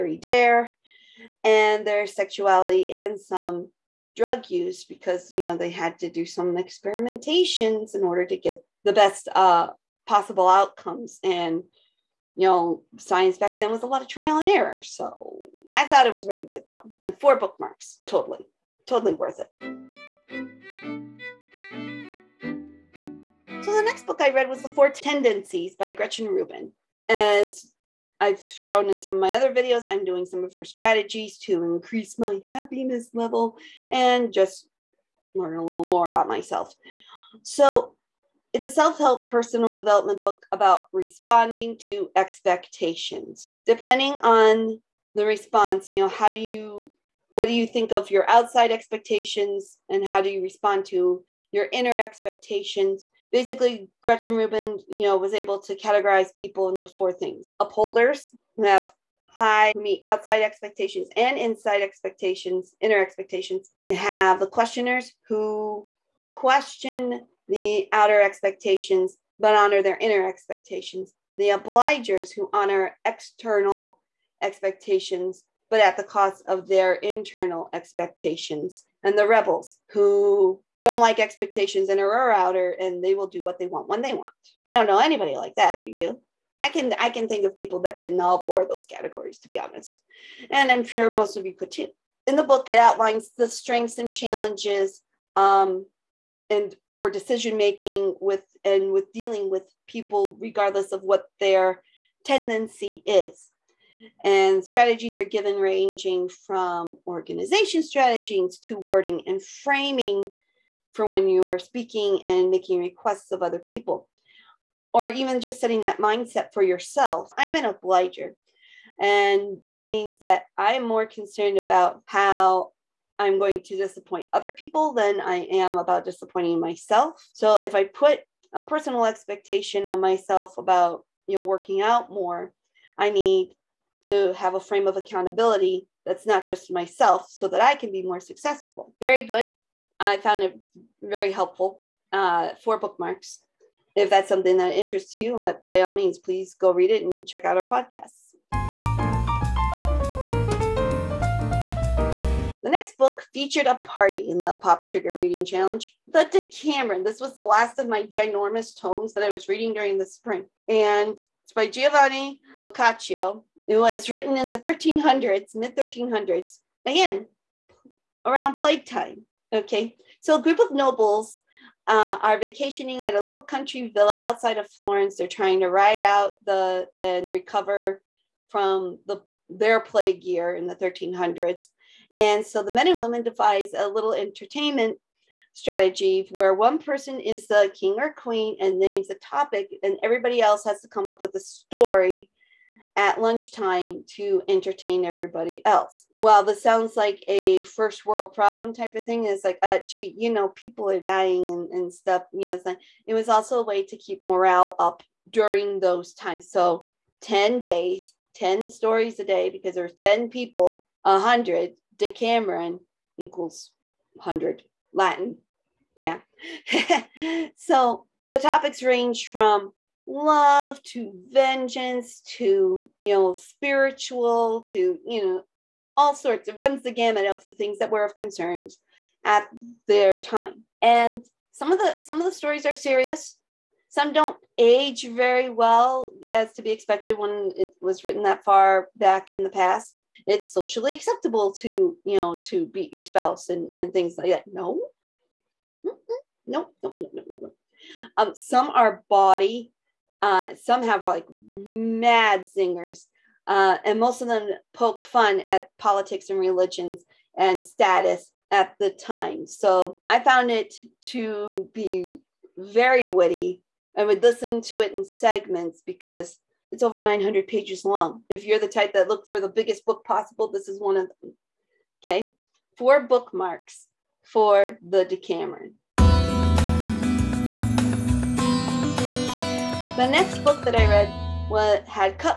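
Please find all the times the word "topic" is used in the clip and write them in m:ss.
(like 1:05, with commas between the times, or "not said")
3:09, 3:38.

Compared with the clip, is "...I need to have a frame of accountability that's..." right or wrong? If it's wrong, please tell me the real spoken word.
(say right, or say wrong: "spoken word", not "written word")
right.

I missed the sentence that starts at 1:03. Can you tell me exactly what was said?
You have the questioners who question the outer expectations but honor their inner expectations.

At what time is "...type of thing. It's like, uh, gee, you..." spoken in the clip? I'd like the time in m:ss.
3:18.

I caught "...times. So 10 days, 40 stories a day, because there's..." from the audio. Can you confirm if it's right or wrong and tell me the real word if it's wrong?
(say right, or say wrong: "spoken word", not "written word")
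wrong: "10", not "40".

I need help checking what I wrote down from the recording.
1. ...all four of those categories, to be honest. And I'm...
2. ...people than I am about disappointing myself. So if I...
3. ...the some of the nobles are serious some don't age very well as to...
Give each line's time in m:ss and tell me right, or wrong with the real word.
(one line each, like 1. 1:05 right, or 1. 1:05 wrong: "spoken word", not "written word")
1. 1:28 right
2. 2:04 right
3. 3:51 wrong: "stories", not "nobles".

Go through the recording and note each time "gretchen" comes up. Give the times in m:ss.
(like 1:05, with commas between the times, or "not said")
0:25, 0:54.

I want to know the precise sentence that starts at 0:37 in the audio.
So it's a self help personal development book about responding to expectations.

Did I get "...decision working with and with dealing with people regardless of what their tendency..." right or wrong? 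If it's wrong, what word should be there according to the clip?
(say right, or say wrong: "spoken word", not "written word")
wrong: "making", not "working".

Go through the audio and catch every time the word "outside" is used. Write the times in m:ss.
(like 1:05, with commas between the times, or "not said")
0:48, 1:00, 2:54.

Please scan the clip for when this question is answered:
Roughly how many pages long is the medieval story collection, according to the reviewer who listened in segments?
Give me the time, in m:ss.
4:26.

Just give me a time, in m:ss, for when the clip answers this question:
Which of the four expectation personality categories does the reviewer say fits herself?
1:57.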